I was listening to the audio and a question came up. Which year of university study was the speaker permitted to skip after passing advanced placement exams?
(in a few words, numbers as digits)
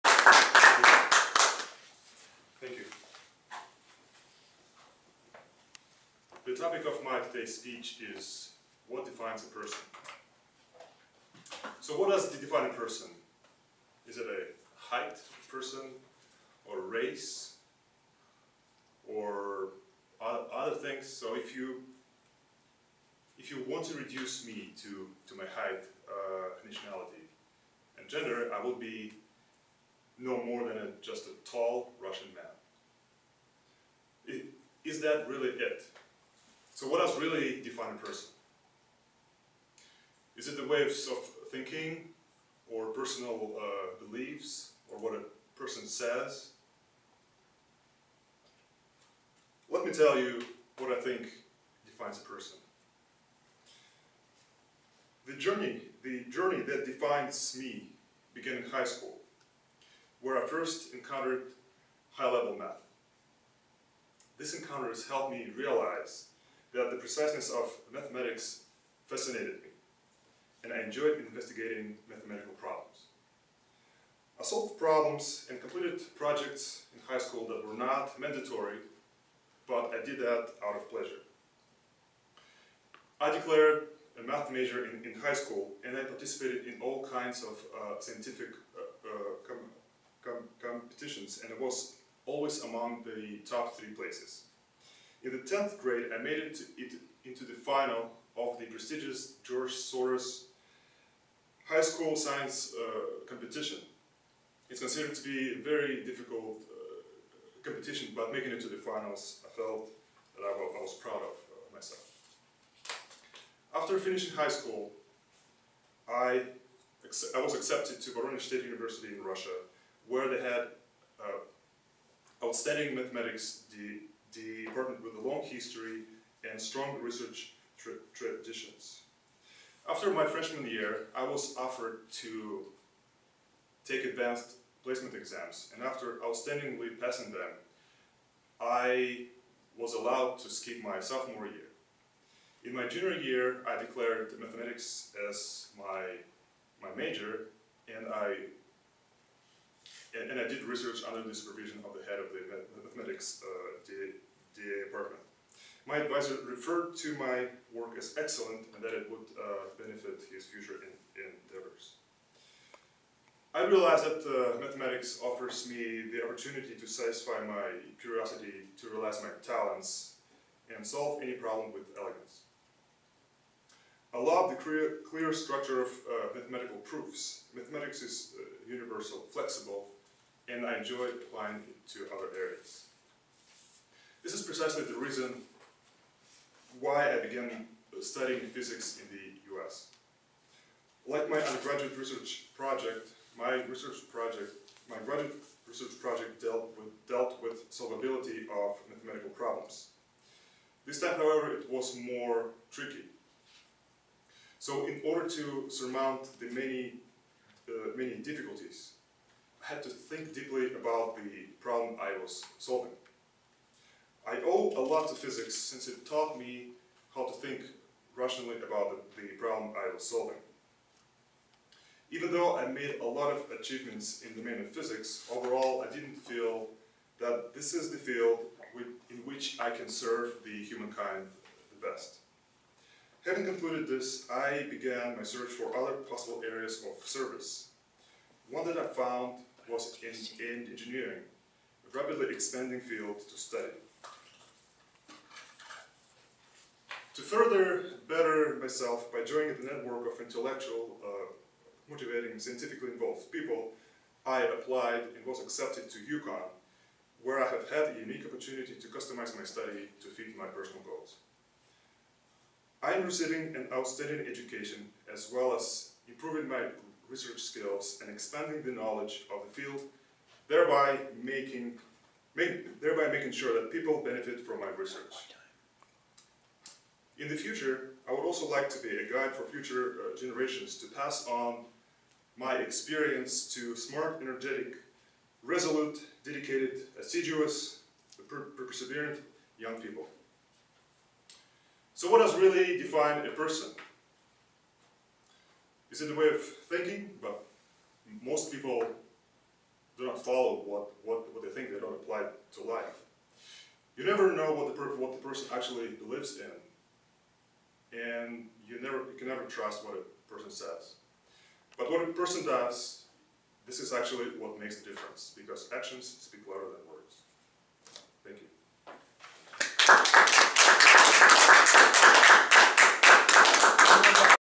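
Sophomore year.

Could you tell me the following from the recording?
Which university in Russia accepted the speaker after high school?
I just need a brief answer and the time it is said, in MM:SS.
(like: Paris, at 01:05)
Voronezh State University, at 01:58.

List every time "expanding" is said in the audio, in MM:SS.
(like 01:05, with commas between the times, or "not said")
04:02, 04:28.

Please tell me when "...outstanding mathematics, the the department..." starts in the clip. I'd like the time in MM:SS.
02:02.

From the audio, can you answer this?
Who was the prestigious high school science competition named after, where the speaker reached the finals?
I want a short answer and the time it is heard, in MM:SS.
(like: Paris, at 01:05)
George Soros, at 01:39.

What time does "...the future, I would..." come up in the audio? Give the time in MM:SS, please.
04:37.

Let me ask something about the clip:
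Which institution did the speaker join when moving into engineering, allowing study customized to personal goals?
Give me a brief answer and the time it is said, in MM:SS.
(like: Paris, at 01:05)
UConn, at 04:15.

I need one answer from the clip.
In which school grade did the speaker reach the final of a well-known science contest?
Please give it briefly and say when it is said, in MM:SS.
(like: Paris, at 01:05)
10th grade, at 01:35.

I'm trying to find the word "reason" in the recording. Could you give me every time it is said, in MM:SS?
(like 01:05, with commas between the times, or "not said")
03:04.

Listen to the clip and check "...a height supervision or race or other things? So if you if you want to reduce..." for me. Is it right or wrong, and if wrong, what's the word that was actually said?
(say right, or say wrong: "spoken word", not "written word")
wrong: "person", not "supervision".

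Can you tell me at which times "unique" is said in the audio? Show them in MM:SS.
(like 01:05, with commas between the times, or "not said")
04:17.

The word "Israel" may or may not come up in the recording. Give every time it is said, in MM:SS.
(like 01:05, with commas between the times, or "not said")
not said.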